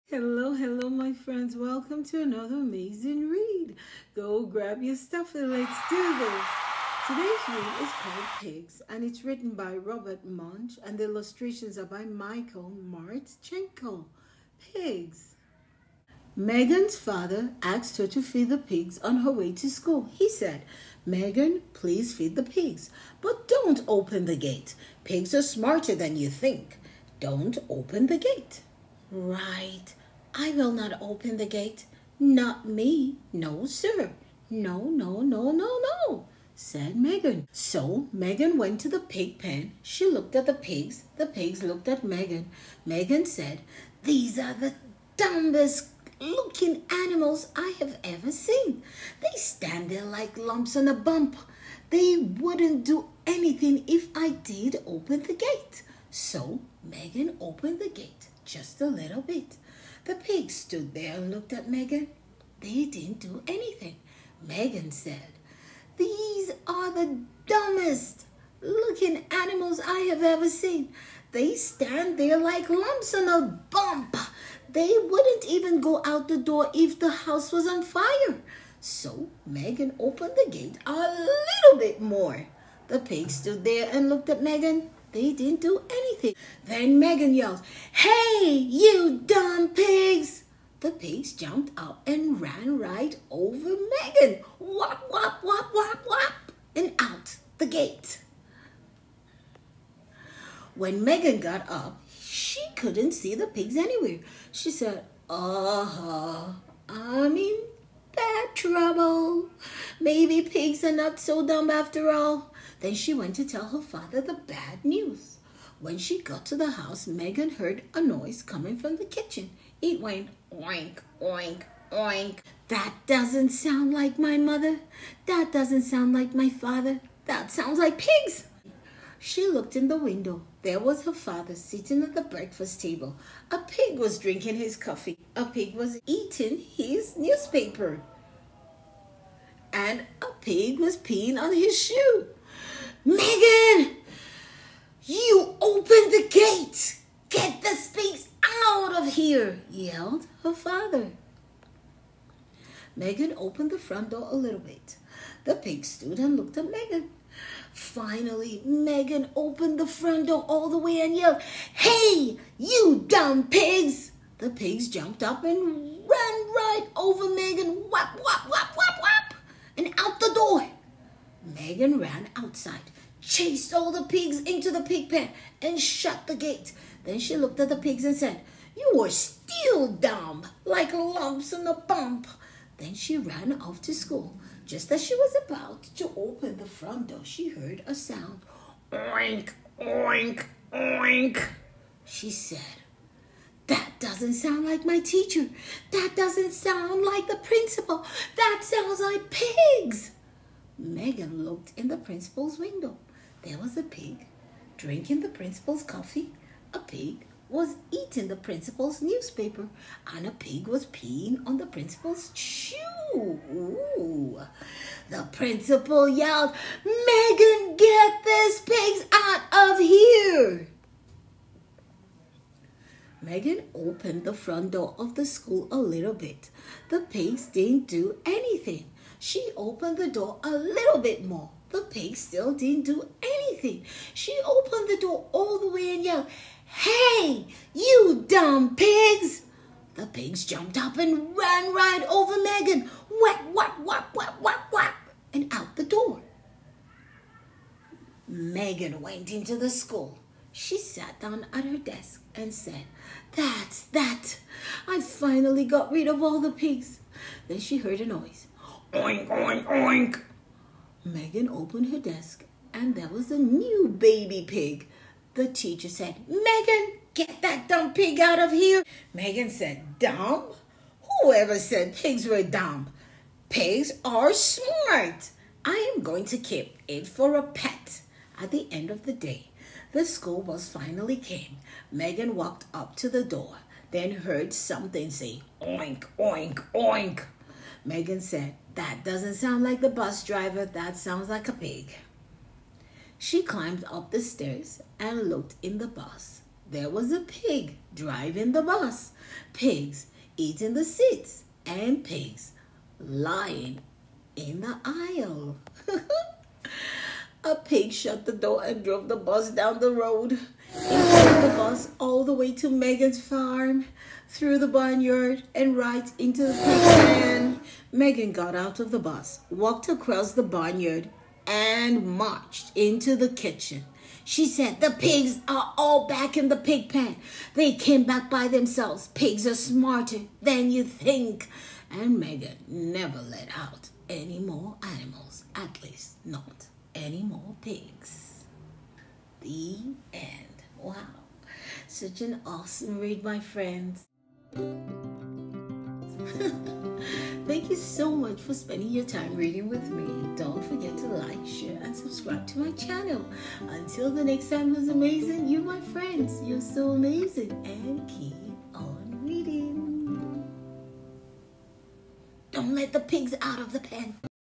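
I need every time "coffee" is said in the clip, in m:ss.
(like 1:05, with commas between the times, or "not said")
2:14, 3:25.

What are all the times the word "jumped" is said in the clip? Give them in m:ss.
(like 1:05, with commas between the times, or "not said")
1:31, 2:44, 4:00.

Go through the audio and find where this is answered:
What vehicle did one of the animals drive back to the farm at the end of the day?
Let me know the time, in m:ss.
4:40.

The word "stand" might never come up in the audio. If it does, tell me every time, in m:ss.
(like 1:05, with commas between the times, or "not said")
0:49, 1:11.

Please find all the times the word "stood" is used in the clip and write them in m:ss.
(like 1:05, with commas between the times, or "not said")
1:00, 1:23, 2:35.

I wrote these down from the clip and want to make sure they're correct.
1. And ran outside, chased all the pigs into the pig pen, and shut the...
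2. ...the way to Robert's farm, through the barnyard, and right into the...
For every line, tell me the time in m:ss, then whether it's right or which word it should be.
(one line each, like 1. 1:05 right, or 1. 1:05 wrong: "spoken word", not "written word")
1. 2:51 right
2. 5:12 wrong: "Megan", not "Robert".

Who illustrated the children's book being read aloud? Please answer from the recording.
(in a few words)
Michael Martchenko.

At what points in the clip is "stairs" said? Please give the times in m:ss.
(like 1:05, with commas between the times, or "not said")
4:54.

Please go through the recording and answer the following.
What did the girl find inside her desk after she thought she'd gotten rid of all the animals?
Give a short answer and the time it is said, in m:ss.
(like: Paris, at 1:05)
a new baby pig, at 4:23.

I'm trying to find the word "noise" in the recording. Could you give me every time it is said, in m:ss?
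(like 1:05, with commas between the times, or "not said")
1:58, 4:18.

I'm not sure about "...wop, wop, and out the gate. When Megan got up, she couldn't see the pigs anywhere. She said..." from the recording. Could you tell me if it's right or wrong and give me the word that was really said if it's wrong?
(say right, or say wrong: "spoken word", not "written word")
right.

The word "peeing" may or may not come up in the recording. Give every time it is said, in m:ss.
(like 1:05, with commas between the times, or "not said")
2:20, 3:30.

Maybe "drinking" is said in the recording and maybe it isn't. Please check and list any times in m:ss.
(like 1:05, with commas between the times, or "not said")
2:14, 3:24.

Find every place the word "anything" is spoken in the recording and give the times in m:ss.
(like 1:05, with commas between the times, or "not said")
0:53, 1:03, 1:25, 3:48, 3:53.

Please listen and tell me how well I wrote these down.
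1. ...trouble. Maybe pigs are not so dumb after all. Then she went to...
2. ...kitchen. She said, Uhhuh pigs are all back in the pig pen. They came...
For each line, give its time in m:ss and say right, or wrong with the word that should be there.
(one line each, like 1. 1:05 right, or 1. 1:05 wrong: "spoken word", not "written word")
1. 1:48 right
2. 5:23 wrong: "The", not "Uhhuh".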